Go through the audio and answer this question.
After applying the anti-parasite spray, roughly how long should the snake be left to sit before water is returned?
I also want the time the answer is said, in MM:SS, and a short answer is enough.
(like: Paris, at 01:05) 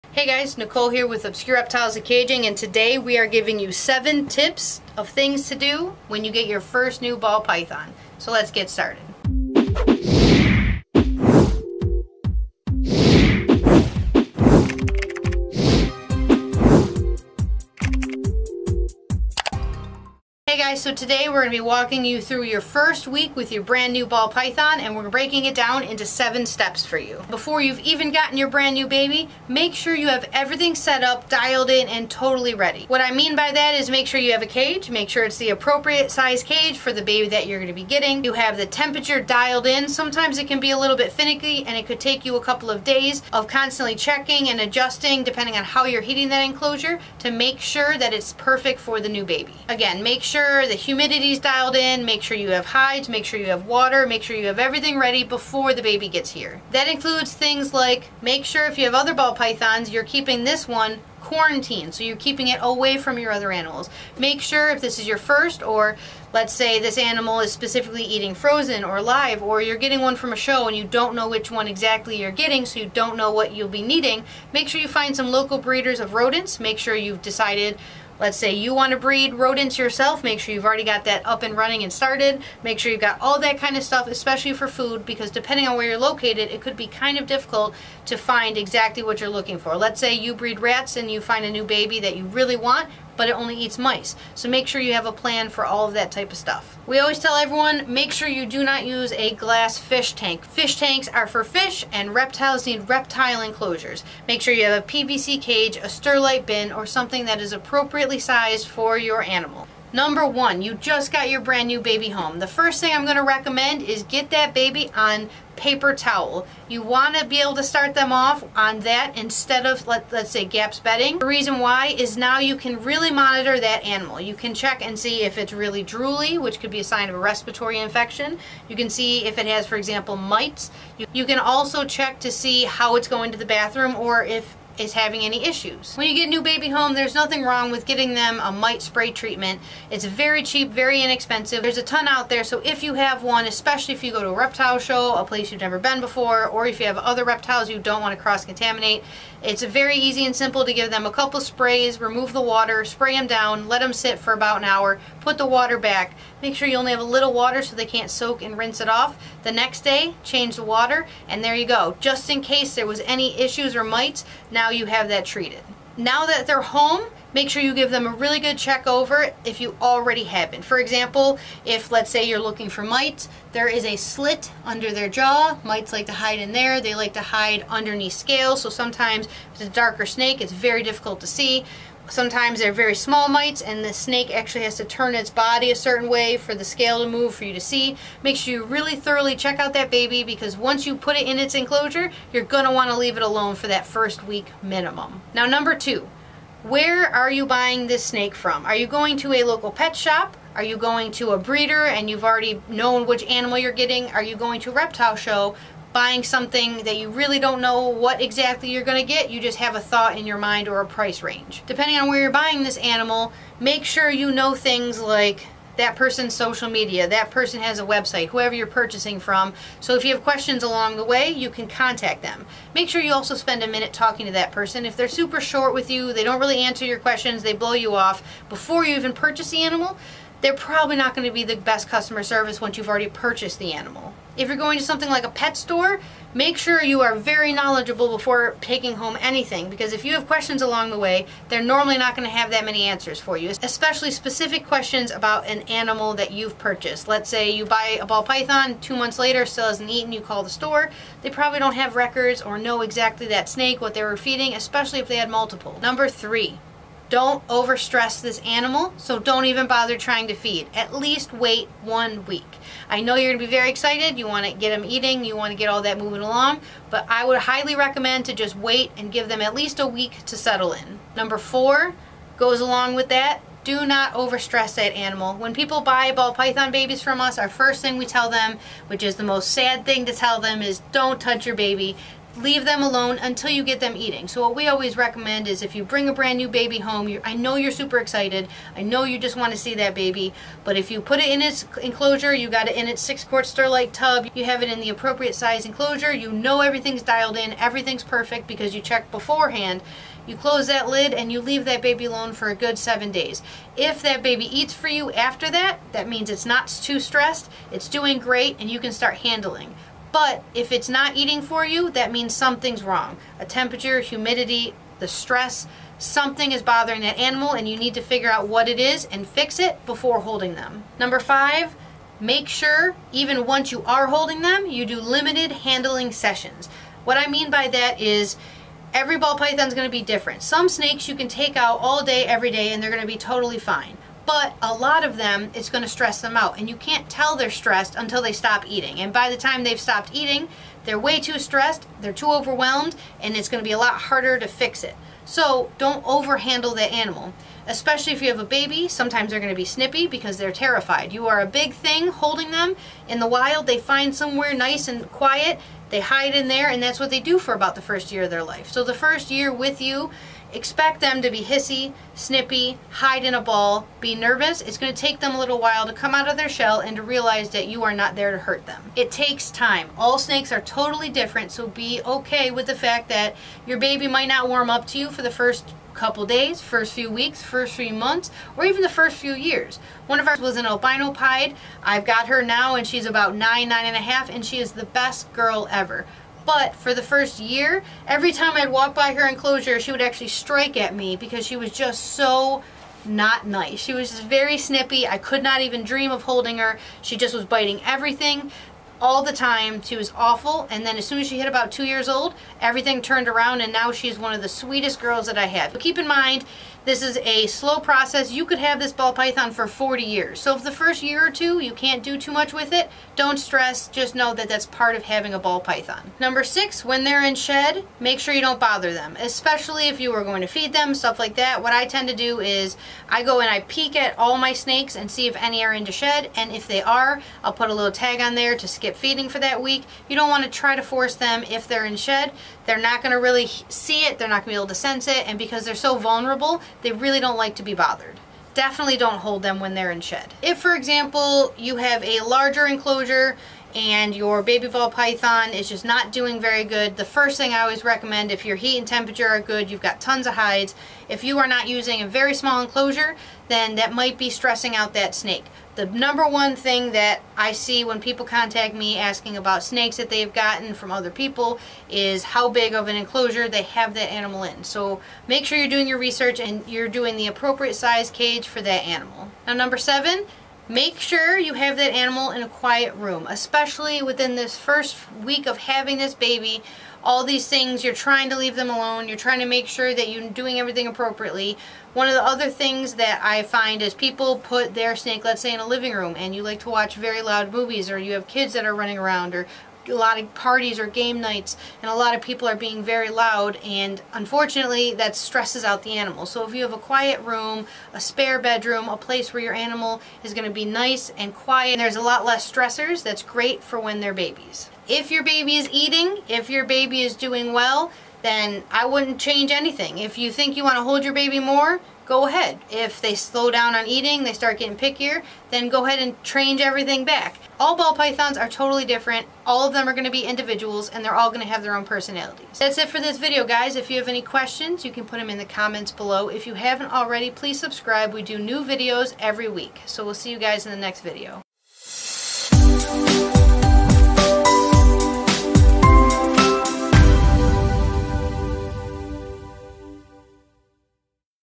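about an hour, at 02:34.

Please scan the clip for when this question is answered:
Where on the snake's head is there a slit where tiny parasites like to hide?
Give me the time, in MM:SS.
02:54.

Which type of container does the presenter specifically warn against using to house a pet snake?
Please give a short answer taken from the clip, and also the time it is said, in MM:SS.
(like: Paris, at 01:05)
glass fish tank, at 01:39.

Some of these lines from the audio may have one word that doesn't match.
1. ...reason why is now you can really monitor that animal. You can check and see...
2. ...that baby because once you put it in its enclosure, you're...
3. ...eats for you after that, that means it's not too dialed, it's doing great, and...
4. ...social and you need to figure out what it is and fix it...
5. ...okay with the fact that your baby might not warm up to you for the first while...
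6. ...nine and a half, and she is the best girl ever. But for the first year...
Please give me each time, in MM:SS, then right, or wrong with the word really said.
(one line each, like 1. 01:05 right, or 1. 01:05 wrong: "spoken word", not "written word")
1. 02:01 right
2. 03:09 right
3. 05:04 wrong: "stressed", not "dialed"
4. 05:17 wrong: "animal", not "social"
5. 06:12 wrong: "couple", not "while"
6. 06:23 right.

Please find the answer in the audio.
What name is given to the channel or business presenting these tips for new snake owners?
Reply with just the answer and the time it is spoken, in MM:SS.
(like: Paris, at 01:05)
Obscure Reptiles and Caging, at 00:01.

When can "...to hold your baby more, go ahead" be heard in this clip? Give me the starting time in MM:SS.
08:30.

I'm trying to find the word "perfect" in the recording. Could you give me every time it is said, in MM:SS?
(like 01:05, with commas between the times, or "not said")
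00:48, 04:58.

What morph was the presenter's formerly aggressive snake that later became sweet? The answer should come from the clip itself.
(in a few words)
albino pied.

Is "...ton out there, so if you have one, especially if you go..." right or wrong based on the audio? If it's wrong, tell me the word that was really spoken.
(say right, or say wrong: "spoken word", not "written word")
right.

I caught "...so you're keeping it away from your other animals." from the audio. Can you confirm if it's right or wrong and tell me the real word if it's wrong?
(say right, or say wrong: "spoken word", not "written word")
right.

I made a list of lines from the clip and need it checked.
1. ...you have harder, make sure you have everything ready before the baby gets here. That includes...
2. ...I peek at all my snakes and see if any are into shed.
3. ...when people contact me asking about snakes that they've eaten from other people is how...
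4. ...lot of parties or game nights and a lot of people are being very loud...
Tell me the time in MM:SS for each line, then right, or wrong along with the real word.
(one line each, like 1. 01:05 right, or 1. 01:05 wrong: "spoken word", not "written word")
1. 00:53 wrong: "water", not "harder"
2. 07:03 right
3. 07:37 wrong: "gotten", not "eaten"
4. 08:09 right.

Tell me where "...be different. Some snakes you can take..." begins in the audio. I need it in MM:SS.
05:29.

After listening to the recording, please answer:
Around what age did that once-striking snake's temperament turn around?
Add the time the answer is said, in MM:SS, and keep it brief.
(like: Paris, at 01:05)
about 2 years old, at 06:41.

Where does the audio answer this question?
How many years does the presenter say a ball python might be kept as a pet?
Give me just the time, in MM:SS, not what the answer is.
06:49.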